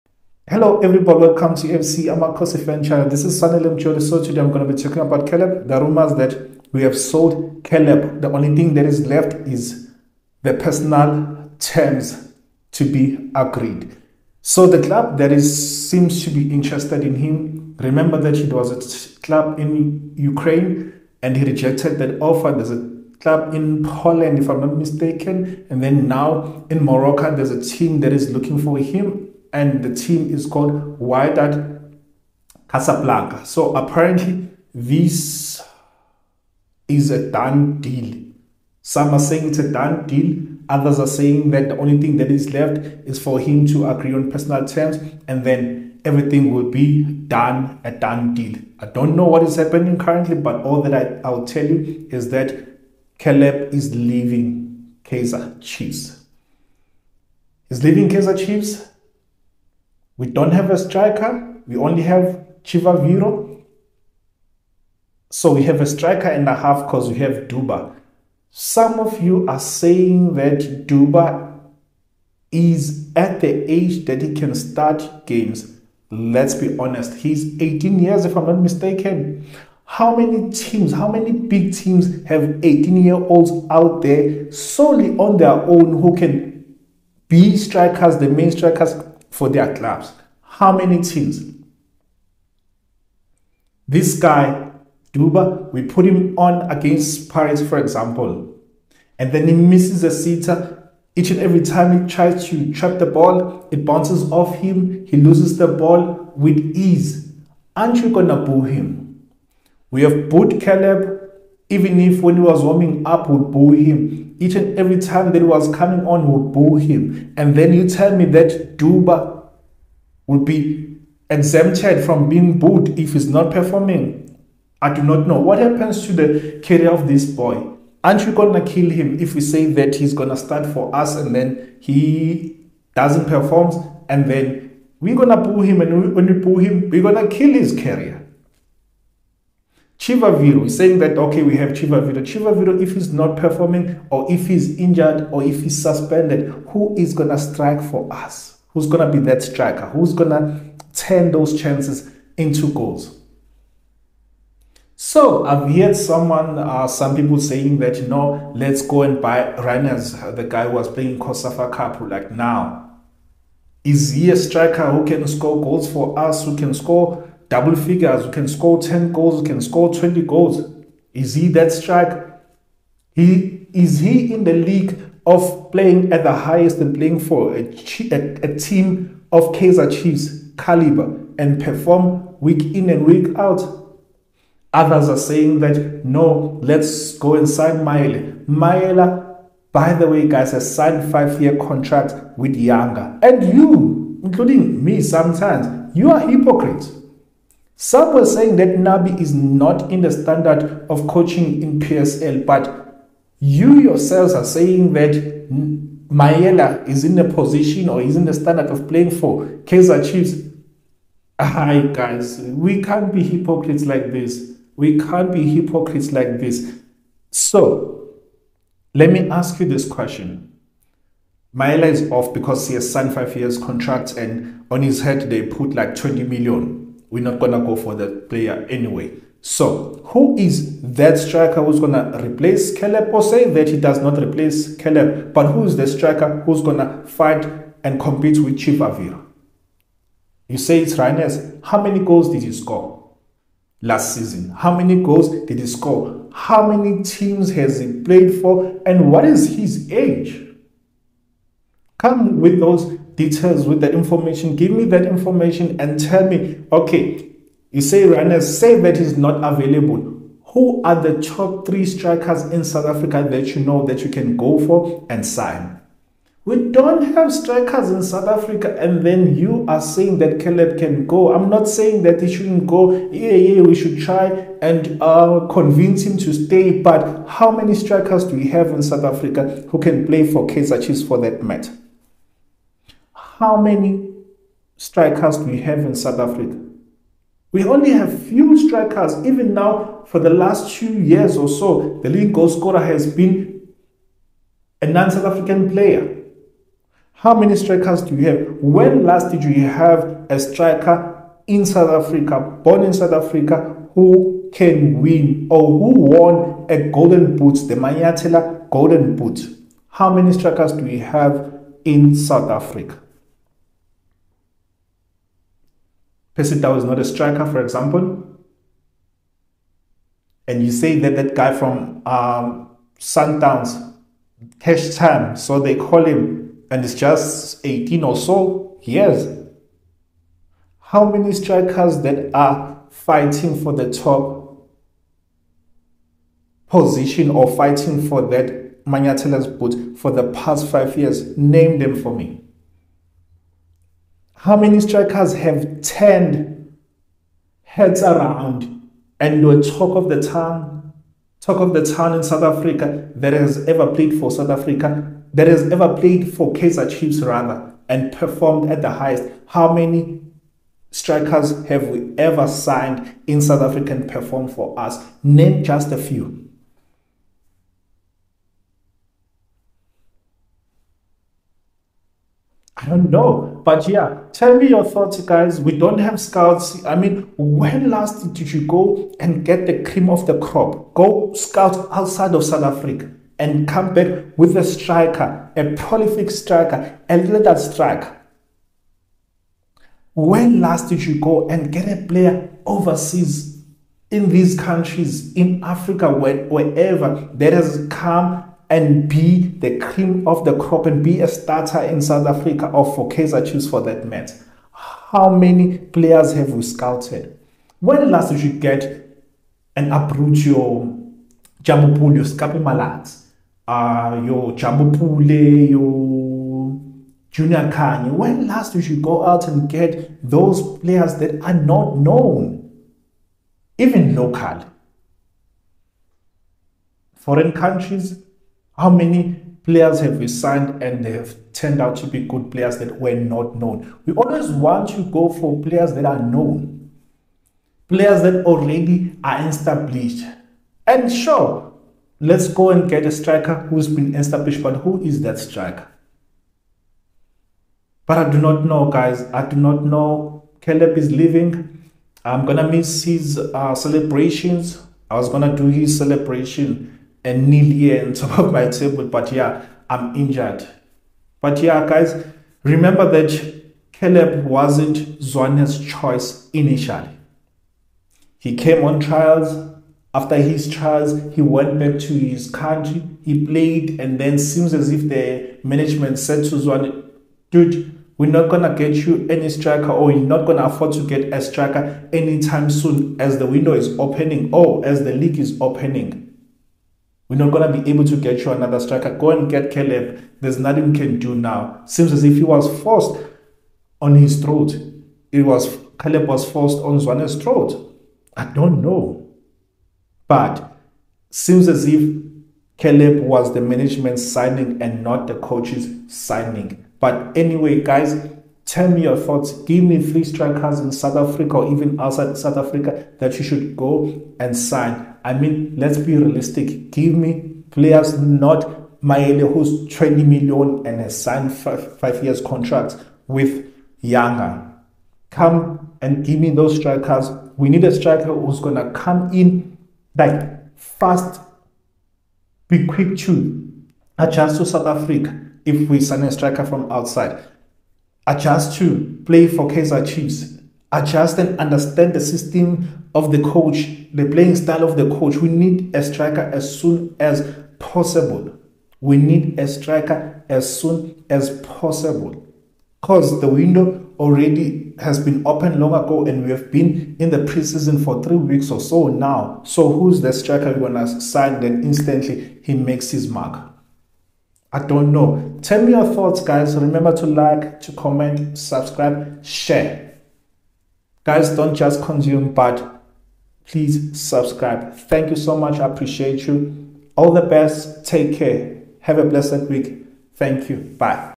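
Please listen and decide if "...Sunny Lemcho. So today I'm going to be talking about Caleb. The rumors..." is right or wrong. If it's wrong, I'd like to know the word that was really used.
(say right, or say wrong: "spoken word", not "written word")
right.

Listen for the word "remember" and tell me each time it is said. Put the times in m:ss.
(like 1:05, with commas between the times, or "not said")
0:17, 7:42, 9:26.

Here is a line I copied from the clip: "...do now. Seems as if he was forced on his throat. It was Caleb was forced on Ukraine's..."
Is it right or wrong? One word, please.
wrong.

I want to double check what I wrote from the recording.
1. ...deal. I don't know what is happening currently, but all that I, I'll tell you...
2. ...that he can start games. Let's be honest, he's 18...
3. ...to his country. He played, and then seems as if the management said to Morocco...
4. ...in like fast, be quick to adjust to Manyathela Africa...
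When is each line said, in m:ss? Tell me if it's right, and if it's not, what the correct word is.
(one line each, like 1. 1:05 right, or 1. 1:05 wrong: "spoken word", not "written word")
1. 0:48 right
2. 1:14 right
3. 7:52 wrong: "Zwane", not "Morocco"
4. 8:49 wrong: "South", not "Manyathela".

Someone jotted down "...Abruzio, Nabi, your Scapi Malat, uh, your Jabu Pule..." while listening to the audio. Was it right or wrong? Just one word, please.
wrong.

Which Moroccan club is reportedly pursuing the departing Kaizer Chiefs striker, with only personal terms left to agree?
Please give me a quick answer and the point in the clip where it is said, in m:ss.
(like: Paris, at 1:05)
Wydad Casablanca, at 0:30.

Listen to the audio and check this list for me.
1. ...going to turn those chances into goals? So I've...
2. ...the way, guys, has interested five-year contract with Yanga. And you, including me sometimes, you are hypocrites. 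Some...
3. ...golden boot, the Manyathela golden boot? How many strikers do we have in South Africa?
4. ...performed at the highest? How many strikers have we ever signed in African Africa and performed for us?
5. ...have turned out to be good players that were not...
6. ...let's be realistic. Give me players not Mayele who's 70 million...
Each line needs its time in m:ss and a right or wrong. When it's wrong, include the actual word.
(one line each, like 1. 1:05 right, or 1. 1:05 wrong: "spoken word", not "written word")
1. 2:30 right
2. 3:09 wrong: "signed", not "interested"
3. 5:06 right
4. 5:58 wrong: "South", not "African"
5. 7:11 right
6. 8:35 wrong: "20", not "70".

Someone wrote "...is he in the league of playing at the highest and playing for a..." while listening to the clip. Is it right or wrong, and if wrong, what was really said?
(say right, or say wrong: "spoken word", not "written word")
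right.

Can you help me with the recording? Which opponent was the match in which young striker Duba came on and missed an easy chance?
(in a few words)
Paris.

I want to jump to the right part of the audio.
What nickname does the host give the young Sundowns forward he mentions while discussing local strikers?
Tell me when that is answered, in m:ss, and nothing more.
5:24.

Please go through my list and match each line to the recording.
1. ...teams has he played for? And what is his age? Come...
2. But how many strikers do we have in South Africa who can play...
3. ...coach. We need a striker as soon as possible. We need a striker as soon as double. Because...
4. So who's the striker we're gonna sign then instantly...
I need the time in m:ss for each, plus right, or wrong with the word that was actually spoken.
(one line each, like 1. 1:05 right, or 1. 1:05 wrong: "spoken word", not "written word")
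1. 4:07 right
2. 4:36 right
3. 9:05 wrong: "possible", not "double"
4. 9:19 right.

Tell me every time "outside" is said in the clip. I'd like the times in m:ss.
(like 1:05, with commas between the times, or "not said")
6:21, 8:31, 8:56.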